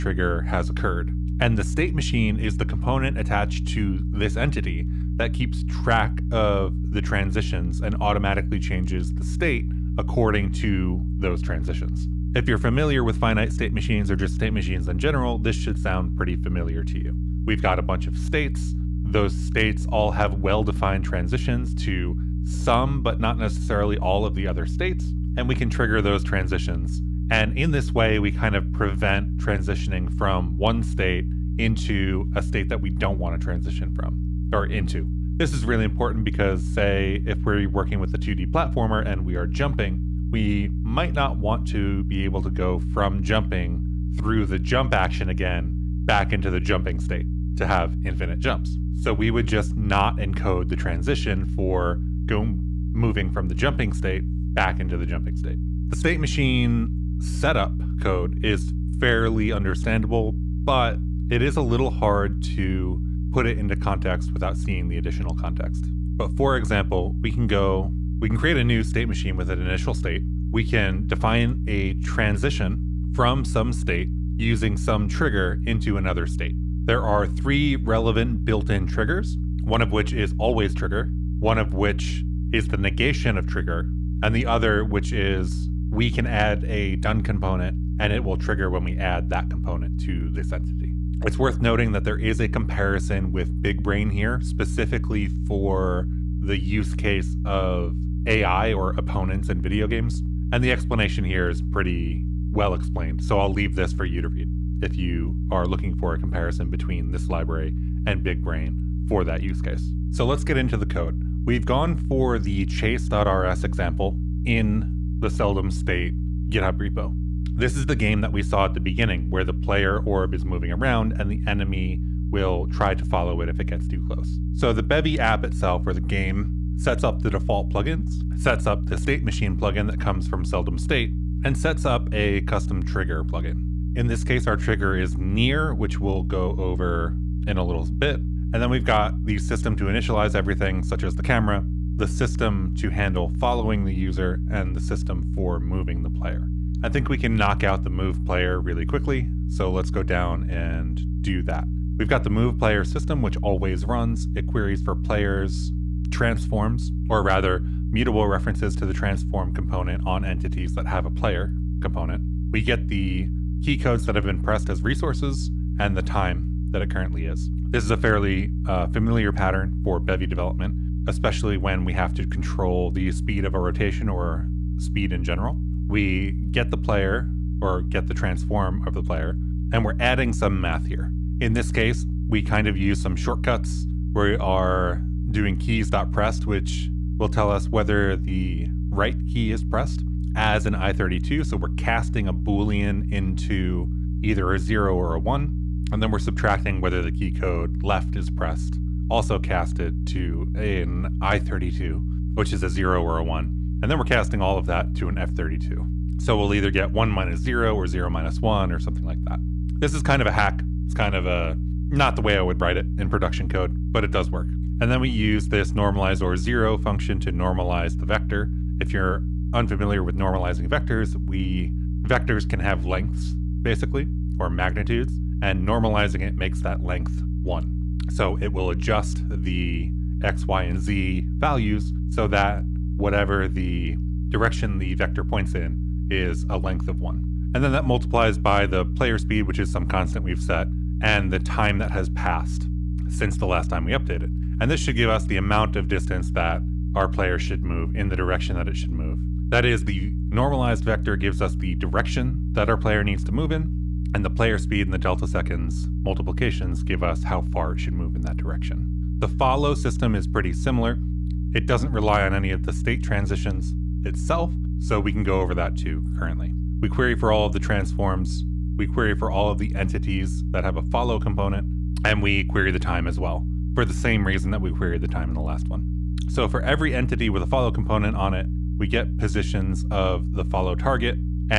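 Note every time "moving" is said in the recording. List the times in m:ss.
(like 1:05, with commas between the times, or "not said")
0:52, 2:00, 2:25.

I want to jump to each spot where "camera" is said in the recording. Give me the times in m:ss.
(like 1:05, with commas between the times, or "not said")
2:21.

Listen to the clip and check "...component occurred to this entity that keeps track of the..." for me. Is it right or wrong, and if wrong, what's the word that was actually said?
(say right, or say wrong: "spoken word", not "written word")
wrong: "attached", not "occurred".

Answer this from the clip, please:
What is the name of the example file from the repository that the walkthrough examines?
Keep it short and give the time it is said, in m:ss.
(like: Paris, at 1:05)
chase.rs, at 1:52.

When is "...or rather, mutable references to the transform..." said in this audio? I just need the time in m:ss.
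2:37.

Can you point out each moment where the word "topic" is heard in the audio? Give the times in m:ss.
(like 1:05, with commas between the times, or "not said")
not said.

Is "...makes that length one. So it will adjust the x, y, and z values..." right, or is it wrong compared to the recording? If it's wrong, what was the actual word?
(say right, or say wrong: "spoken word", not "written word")
right.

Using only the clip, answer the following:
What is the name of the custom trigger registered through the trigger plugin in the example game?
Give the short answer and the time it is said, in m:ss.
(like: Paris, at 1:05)
near, at 2:15.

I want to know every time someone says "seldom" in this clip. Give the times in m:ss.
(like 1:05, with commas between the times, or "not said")
1:55, 2:10.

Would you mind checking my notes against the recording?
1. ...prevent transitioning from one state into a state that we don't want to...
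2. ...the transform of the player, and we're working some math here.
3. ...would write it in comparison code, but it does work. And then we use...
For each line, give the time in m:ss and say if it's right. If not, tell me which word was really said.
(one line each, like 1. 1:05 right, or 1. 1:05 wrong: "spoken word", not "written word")
1. 0:28 right
2. 2:58 wrong: "adding", not "working"
3. 3:32 wrong: "production", not "comparison".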